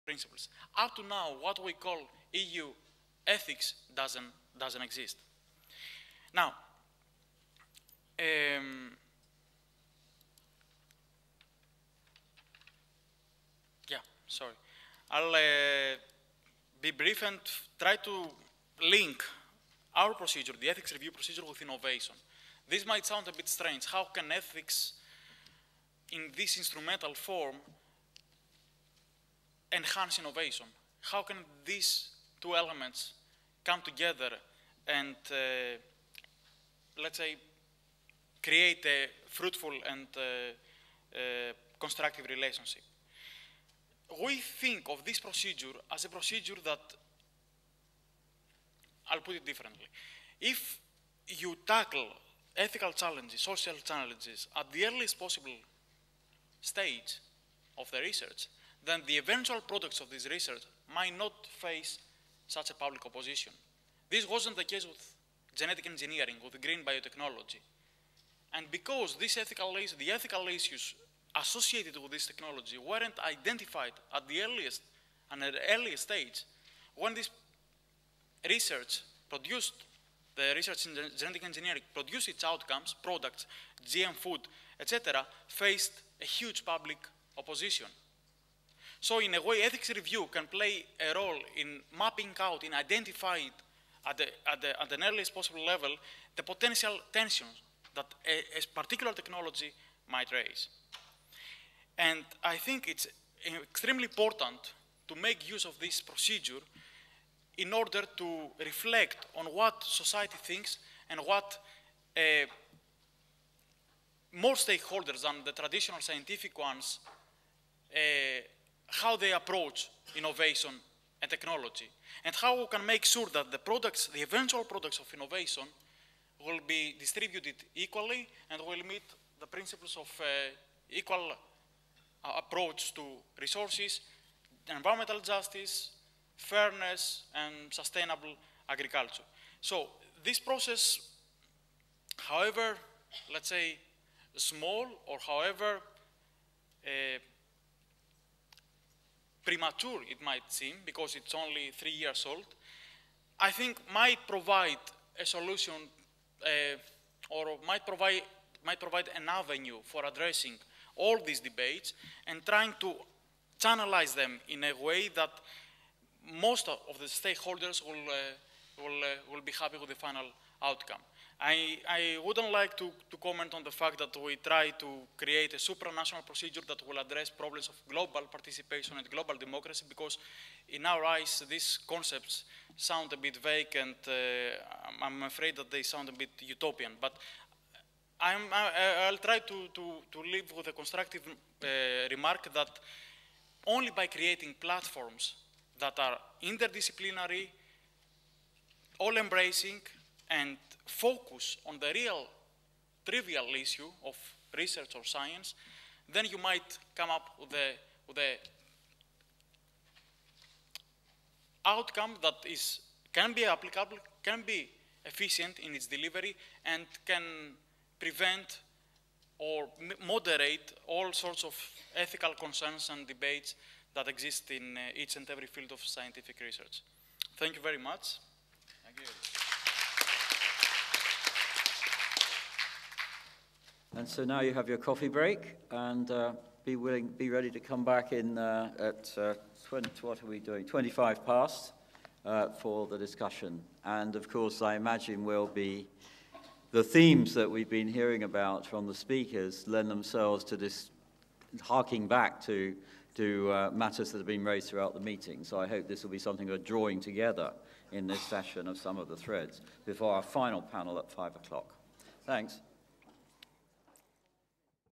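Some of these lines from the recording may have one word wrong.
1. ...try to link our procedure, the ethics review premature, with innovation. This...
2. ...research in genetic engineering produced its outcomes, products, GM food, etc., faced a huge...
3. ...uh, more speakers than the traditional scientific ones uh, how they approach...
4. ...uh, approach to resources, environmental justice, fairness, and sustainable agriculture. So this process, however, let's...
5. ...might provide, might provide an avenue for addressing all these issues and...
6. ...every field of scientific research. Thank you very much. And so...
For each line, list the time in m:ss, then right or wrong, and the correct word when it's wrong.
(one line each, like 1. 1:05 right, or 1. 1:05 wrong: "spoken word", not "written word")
1. 0:17 wrong: "procedure", not "premature"
2. 1:20 right
3. 1:52 wrong: "stakeholders", not "speakers"
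4. 2:12 right
5. 2:37 wrong: "debates", not "issues"
6. 3:45 right.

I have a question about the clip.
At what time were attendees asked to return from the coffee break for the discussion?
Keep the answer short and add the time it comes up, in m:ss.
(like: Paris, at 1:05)
25 past, at 4:00.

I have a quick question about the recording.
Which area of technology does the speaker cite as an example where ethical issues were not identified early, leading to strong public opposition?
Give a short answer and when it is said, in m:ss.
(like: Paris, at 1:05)
green biotechnology, at 1:06.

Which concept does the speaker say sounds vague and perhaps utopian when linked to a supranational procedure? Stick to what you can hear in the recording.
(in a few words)
global democracy.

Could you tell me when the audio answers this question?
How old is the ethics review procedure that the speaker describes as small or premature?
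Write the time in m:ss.
2:31.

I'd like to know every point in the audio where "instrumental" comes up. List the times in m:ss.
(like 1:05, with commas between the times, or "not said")
0:26.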